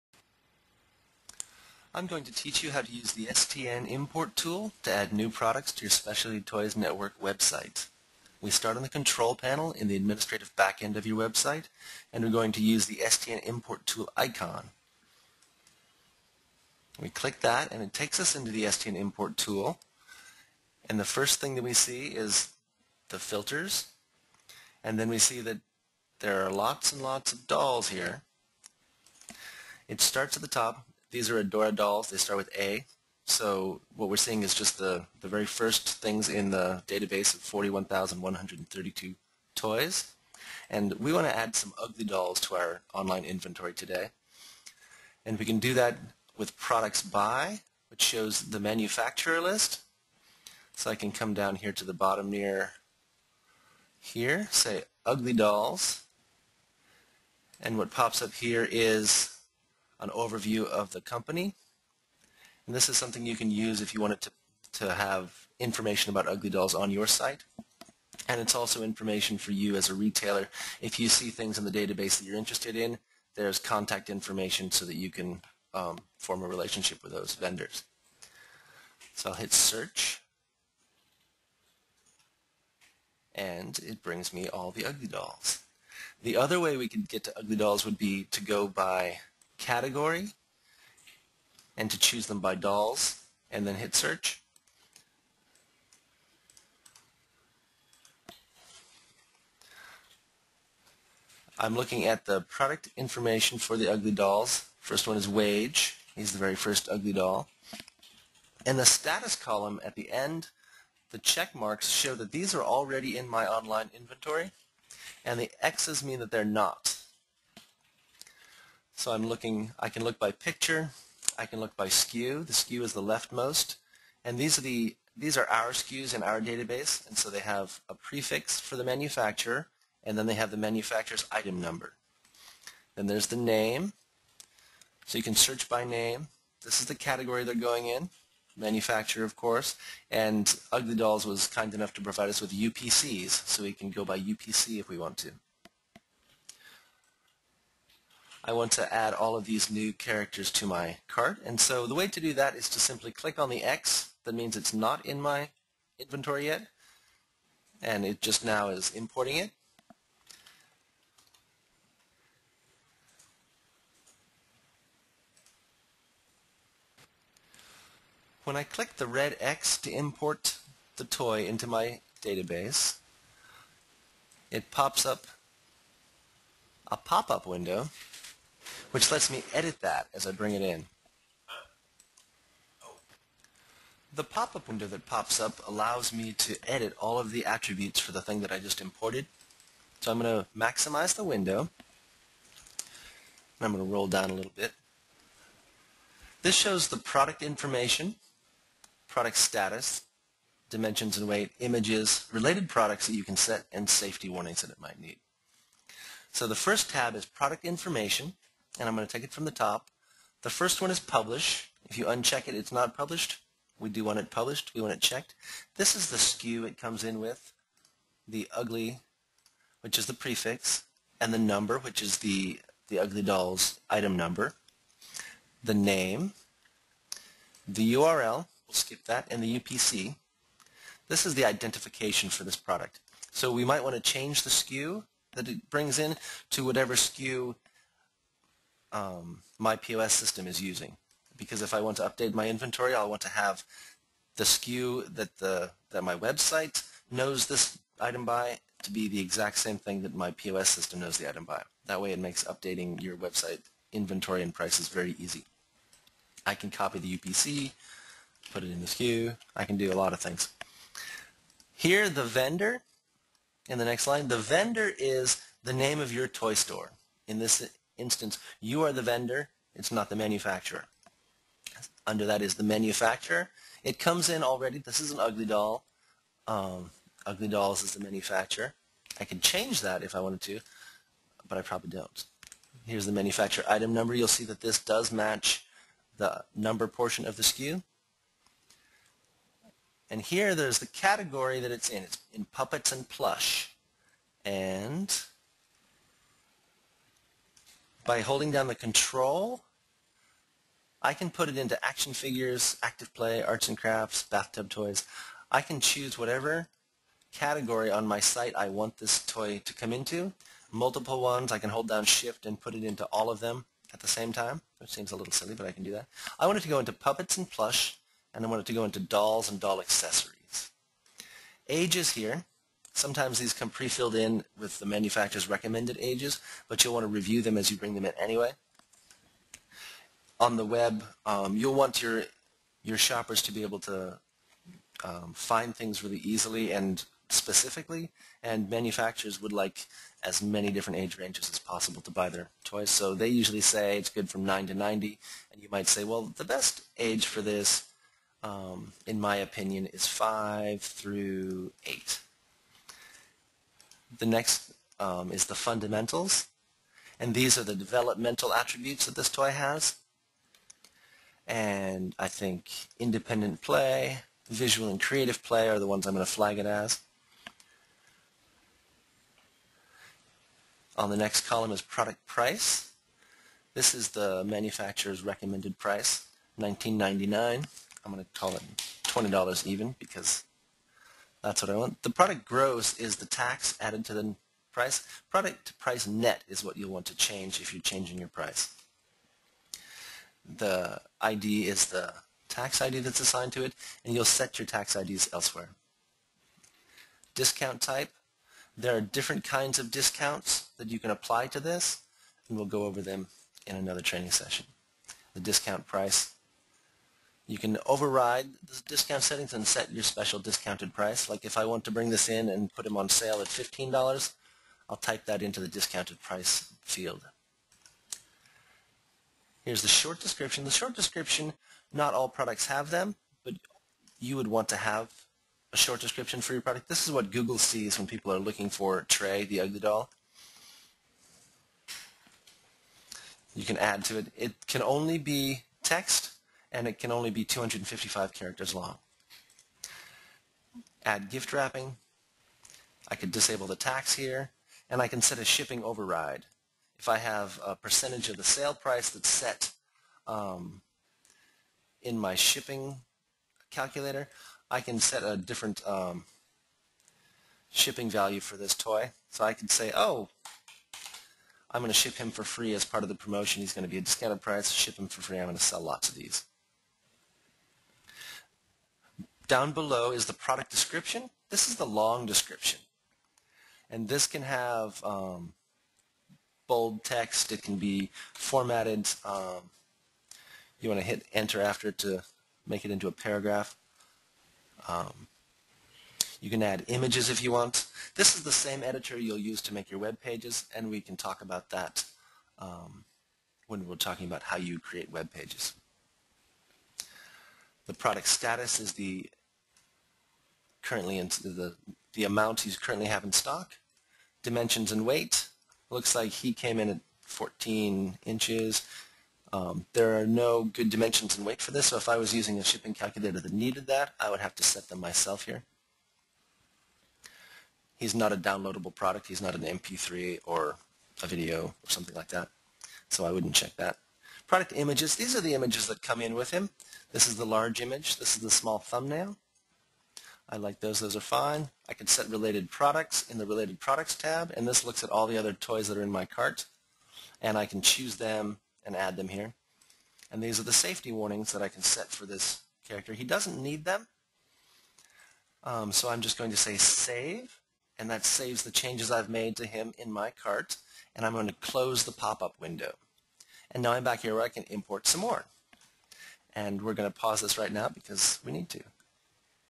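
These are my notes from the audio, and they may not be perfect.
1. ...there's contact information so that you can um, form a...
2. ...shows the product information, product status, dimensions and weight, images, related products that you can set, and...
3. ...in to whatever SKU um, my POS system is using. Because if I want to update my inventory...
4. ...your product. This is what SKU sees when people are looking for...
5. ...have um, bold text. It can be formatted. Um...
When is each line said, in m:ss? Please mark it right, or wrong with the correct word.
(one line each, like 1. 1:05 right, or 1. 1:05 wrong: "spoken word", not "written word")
1. 1:13 right
2. 3:16 right
3. 3:55 right
4. 7:06 wrong: "Google", not "SKU"
5. 7:54 right.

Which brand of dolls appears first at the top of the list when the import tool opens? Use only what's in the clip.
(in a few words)
Adora.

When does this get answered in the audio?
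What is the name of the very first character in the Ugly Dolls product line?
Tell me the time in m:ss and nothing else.
1:45.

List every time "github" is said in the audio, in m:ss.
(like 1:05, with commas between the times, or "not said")
not said.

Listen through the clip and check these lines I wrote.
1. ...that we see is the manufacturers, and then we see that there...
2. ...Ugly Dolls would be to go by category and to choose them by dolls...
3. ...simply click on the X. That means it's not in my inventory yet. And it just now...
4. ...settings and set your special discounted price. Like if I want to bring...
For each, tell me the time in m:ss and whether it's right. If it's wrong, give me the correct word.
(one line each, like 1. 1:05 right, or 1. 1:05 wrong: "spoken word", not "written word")
1. 0:21 wrong: "filters", not "manufacturers"
2. 1:27 right
3. 2:32 right
4. 6:49 right.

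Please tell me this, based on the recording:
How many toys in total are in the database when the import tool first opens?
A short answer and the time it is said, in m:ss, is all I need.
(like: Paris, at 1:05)
41,132, at 0:37.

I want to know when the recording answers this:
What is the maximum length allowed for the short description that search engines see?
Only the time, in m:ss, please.
7:17.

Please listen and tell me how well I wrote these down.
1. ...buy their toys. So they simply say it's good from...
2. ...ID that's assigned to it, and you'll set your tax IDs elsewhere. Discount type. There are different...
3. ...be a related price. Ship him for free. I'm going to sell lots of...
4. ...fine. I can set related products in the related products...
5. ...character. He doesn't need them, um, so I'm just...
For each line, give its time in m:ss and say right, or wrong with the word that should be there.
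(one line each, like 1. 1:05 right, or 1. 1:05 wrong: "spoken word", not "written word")
1. 5:42 wrong: "usually", not "simply"
2. 6:32 right
3. 7:43 wrong: "discounted", not "related"
4. 8:51 right
5. 9:02 right.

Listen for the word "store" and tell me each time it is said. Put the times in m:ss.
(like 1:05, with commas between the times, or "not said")
4:26.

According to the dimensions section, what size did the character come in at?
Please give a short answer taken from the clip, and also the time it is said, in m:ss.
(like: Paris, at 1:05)
14 inches, at 8:27.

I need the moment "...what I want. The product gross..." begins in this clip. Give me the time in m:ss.
6:21.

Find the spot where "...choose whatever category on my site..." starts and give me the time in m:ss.
5:05.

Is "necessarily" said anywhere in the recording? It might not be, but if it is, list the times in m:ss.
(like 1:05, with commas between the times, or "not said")
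not said.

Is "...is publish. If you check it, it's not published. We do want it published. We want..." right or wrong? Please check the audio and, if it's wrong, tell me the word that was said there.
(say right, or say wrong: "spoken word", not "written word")
wrong: "uncheck", not "check".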